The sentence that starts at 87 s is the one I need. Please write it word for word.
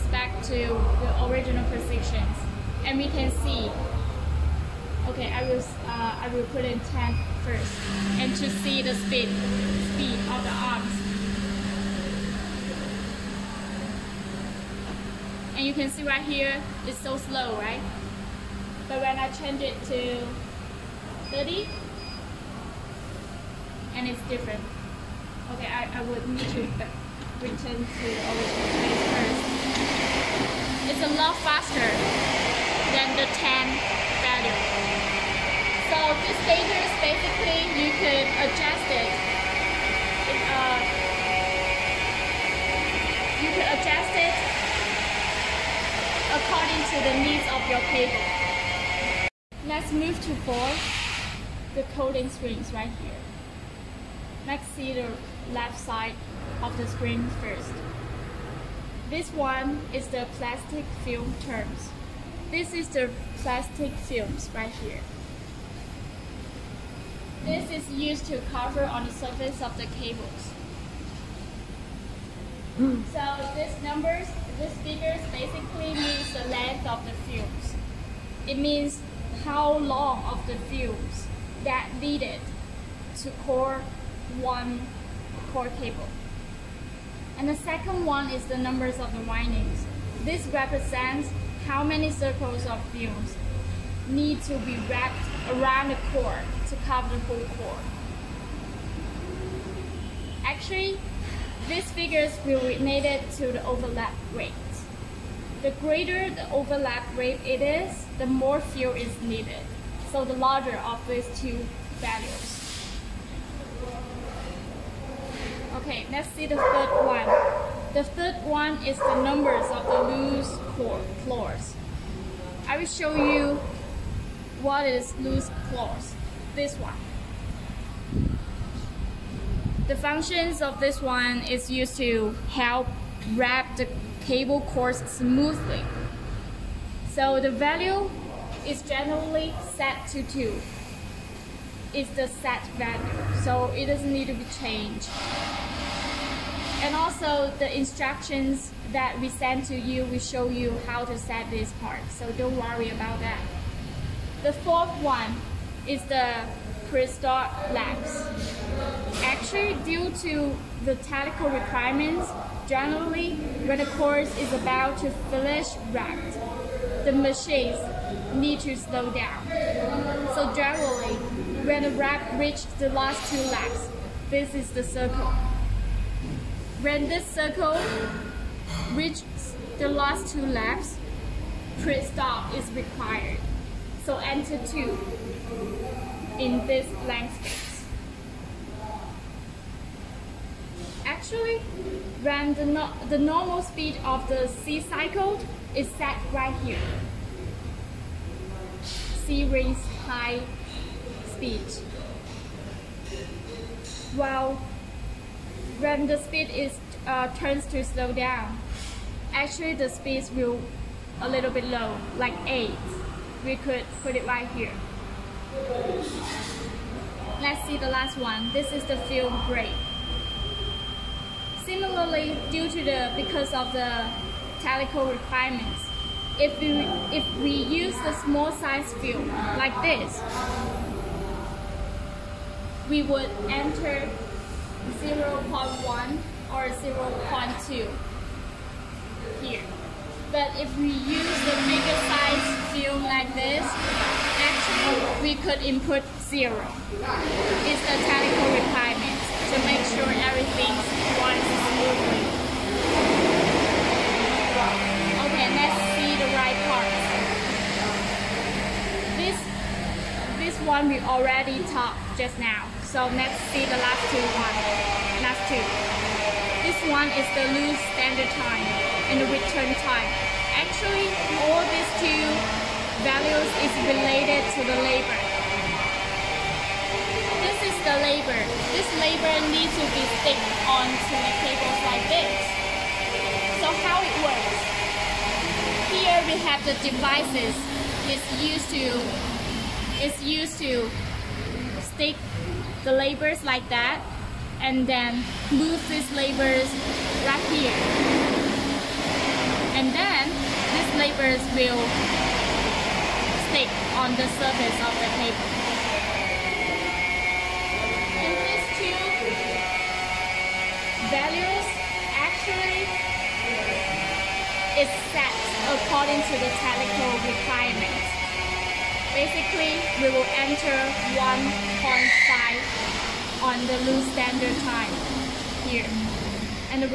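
And the second one is the numbers of the windings.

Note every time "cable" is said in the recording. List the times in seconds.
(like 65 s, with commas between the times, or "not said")
47 s, 70 s, 85 s, 134 s, 281 s.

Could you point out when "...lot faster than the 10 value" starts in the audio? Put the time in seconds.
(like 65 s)
31 s.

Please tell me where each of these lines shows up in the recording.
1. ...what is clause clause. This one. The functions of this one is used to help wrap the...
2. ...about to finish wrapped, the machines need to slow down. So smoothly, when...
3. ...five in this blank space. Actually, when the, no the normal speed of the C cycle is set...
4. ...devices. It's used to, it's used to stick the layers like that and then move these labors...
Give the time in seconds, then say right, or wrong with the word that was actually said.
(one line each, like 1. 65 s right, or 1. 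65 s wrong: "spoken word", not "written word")
1. 124 s wrong: "loose", not "clause"
2. 164 s wrong: "generally", not "smoothly"
3. 184 s wrong: "two", not "five"
4. 286 s wrong: "labors", not "layers".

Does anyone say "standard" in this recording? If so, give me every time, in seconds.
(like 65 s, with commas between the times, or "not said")
267 s, 324 s.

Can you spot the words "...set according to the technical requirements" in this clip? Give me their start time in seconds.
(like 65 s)
315 s.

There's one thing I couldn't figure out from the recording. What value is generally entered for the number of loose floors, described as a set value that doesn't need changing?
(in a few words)
2.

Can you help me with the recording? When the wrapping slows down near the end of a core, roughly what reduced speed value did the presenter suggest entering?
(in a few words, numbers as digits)
8.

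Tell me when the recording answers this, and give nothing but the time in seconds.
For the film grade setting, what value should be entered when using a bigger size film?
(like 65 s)
246 s.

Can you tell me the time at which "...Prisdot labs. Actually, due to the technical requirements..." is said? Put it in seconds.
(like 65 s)
156 s.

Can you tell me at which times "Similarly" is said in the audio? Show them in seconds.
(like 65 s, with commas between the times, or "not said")
221 s.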